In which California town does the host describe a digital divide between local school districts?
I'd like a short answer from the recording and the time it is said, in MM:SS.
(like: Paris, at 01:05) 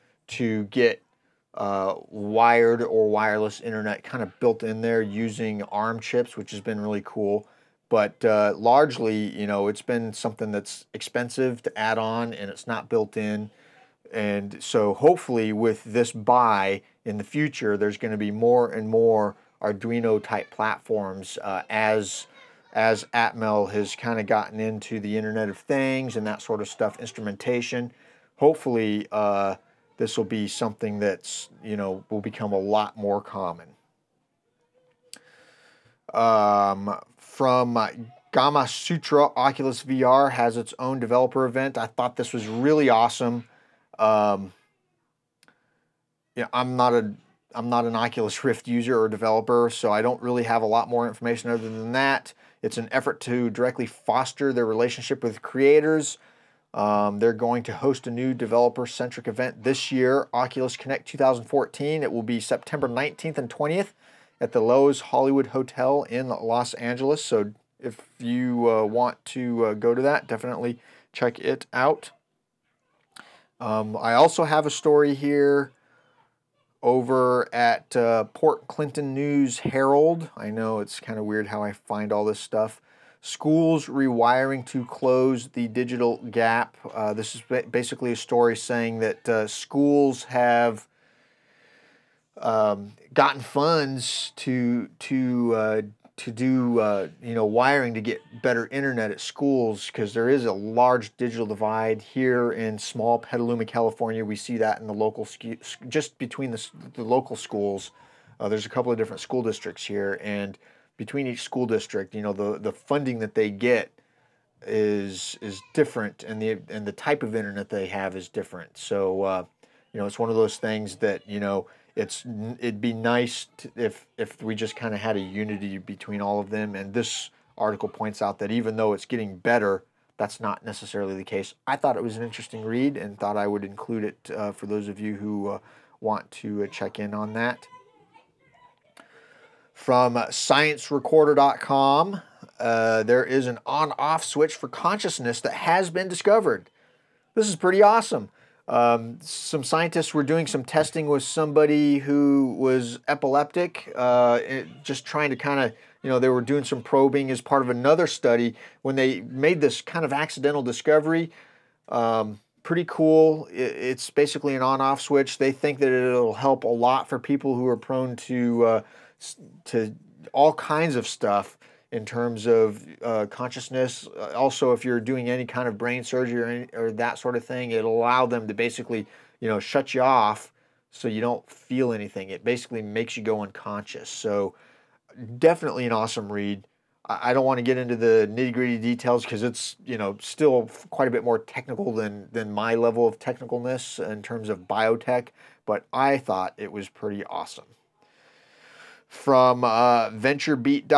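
Petaluma, at 01:43.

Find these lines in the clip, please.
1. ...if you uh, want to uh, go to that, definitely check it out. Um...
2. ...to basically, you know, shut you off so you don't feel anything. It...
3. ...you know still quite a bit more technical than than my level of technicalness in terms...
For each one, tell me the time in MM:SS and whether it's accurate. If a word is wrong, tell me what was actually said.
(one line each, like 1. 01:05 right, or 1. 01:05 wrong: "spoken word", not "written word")
1. 01:07 right
2. 02:58 right
3. 03:09 right.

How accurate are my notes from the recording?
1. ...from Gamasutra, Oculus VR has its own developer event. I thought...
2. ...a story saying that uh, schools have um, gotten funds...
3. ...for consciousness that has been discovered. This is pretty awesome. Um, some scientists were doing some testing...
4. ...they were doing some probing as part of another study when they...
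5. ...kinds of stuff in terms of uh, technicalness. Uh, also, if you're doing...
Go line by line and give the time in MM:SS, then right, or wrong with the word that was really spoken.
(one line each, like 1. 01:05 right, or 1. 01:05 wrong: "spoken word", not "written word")
1. 00:37 right
2. 01:28 right
3. 02:24 right
4. 02:36 right
5. 02:50 wrong: "consciousness", not "technicalness".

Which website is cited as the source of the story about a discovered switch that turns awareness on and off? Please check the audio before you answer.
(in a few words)
ScienceRecorder.com.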